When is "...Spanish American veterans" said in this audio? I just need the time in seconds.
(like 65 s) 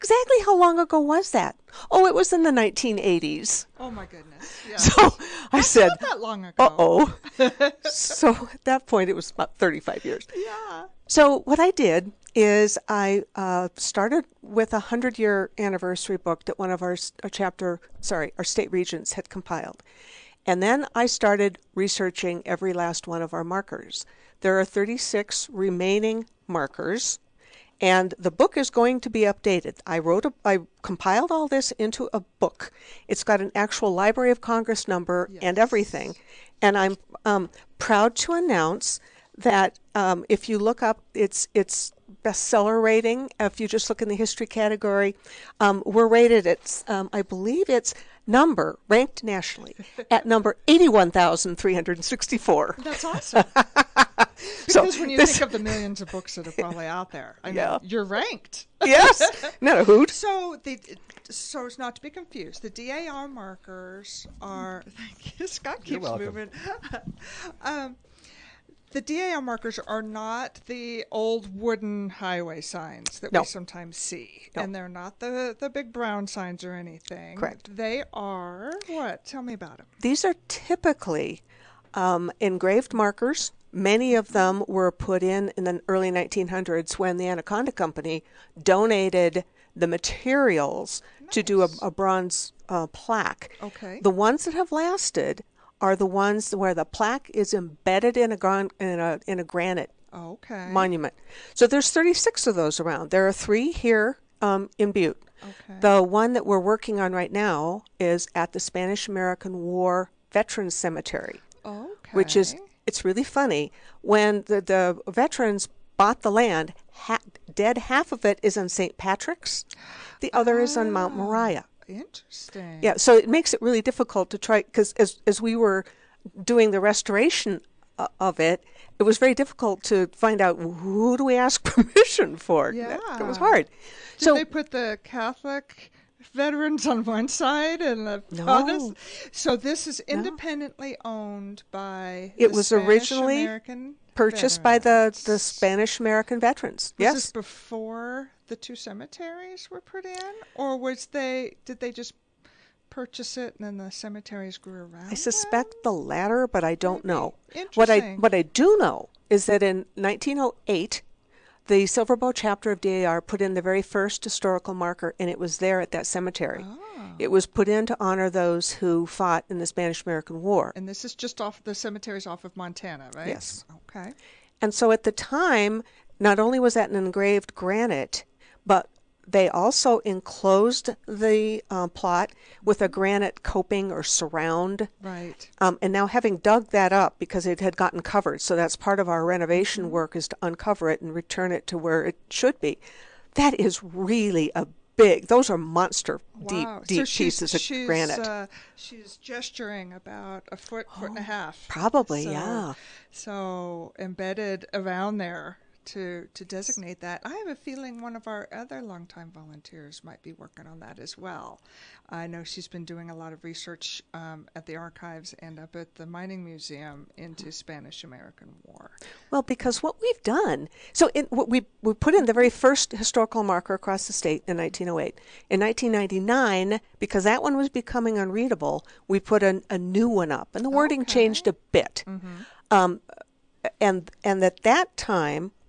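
145 s.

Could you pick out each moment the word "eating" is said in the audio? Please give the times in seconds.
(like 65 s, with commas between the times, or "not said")
not said.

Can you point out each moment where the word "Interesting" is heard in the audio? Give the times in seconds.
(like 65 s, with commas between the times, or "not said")
121 s, 157 s.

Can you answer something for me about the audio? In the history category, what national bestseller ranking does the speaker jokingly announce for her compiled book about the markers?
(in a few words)
81,364.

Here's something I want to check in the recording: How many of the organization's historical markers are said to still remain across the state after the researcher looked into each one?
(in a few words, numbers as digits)
36.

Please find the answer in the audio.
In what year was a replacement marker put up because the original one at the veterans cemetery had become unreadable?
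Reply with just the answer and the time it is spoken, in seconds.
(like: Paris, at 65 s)
1999, at 225 s.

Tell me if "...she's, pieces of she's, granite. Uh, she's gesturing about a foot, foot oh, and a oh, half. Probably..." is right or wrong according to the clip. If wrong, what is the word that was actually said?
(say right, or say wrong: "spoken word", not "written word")
right.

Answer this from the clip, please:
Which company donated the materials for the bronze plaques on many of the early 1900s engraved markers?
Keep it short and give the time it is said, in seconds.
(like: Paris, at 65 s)
Anaconda Company, at 87 s.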